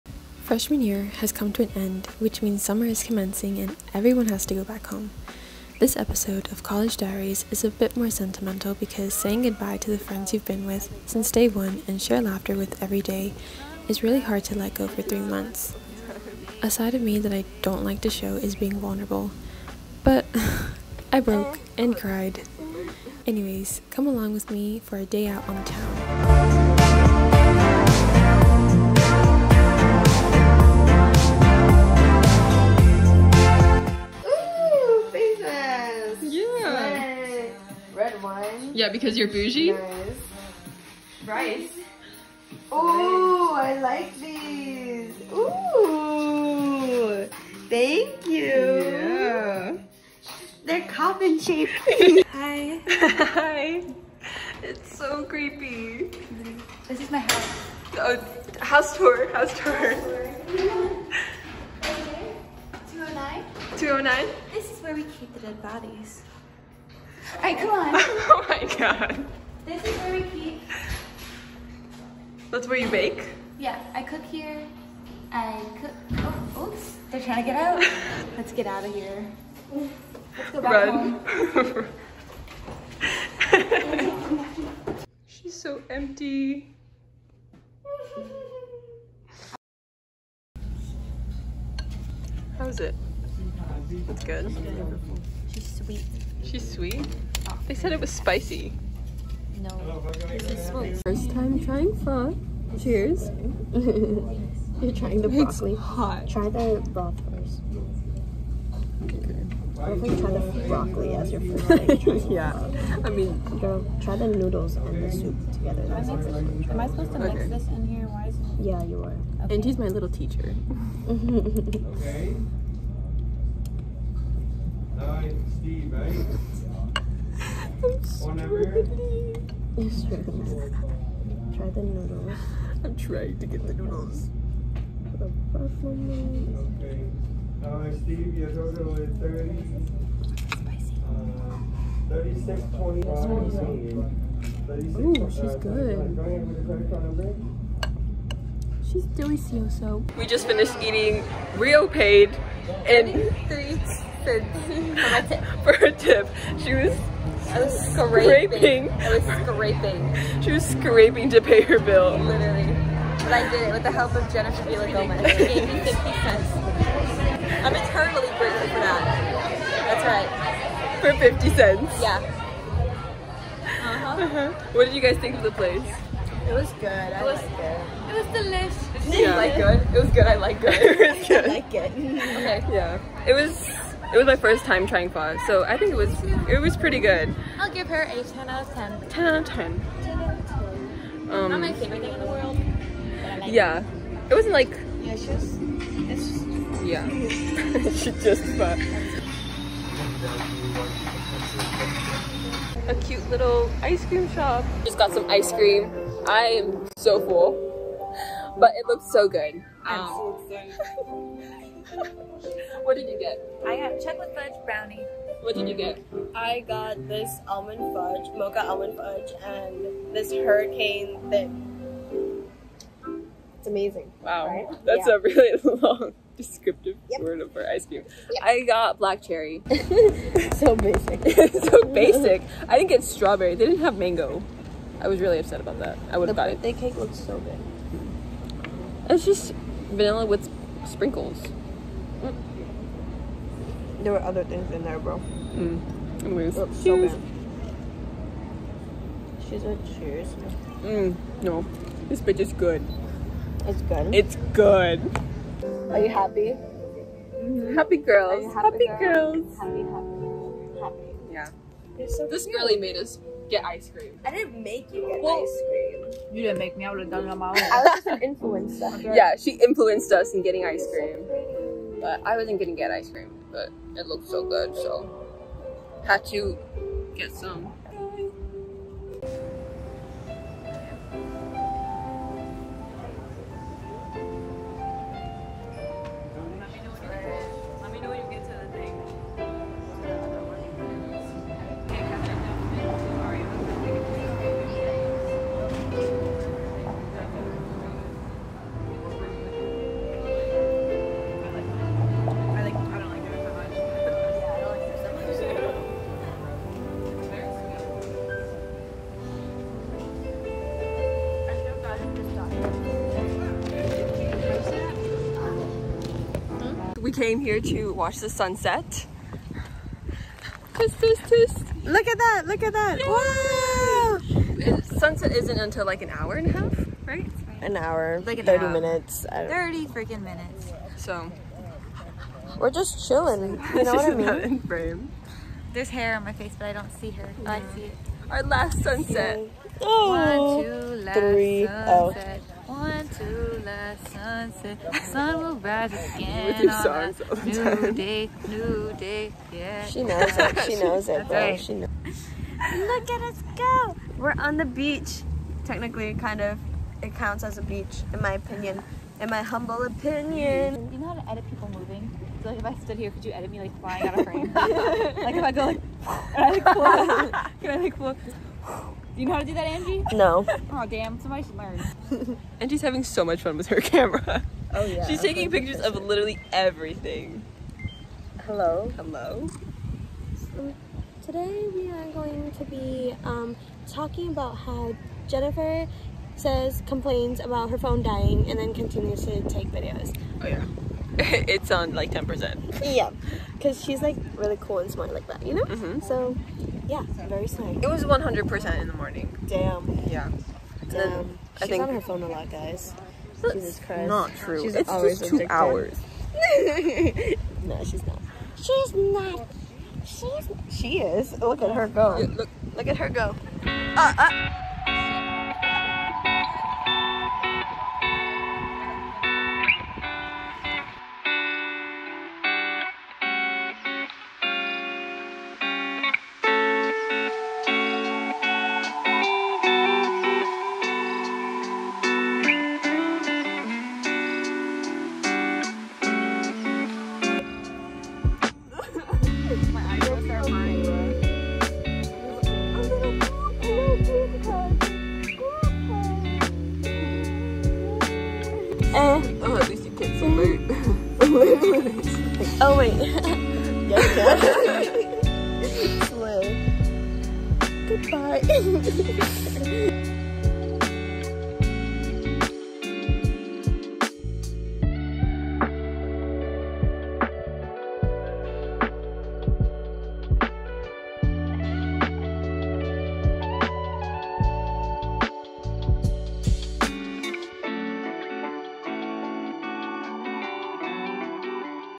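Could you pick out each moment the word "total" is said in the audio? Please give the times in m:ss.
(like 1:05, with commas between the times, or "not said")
2:18.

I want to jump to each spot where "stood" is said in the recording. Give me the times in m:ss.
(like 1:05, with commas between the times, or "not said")
6:02.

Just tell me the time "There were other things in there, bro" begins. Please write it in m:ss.
4:04.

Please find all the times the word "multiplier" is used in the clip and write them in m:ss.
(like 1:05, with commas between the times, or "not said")
not said.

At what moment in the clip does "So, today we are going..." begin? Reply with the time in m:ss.
6:20.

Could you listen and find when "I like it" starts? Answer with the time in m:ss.
3:01.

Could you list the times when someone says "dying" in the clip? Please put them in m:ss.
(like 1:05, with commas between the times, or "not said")
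6:28.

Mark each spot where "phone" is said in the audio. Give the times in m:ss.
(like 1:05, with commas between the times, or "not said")
6:27, 6:42.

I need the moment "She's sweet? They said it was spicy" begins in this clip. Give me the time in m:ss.
1:36.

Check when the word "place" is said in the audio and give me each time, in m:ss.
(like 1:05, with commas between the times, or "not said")
2:55.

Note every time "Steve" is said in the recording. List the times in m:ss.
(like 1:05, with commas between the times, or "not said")
2:05, 2:18.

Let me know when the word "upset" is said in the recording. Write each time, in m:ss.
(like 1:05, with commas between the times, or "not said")
3:55.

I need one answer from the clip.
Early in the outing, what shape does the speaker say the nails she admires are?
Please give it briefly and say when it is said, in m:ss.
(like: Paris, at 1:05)
Coffin shaped, at 0:50.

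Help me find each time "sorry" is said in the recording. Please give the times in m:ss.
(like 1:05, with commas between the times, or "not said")
6:37.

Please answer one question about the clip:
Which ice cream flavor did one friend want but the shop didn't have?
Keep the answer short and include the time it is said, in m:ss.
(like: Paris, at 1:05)
Mango, at 3:53.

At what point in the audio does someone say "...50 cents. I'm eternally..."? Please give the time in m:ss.
2:45.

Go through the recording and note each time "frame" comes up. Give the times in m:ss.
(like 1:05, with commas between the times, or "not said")
5:34, 6:04.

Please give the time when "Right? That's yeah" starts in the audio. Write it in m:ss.
3:44.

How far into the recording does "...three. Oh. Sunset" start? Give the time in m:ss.
5:41.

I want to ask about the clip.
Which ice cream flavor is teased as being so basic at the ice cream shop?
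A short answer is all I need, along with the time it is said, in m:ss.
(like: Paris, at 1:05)
Black cherry, at 3:48.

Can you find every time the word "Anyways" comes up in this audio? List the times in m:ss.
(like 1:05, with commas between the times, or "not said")
0:23, 4:06.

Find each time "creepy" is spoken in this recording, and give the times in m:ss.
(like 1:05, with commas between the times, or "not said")
0:55.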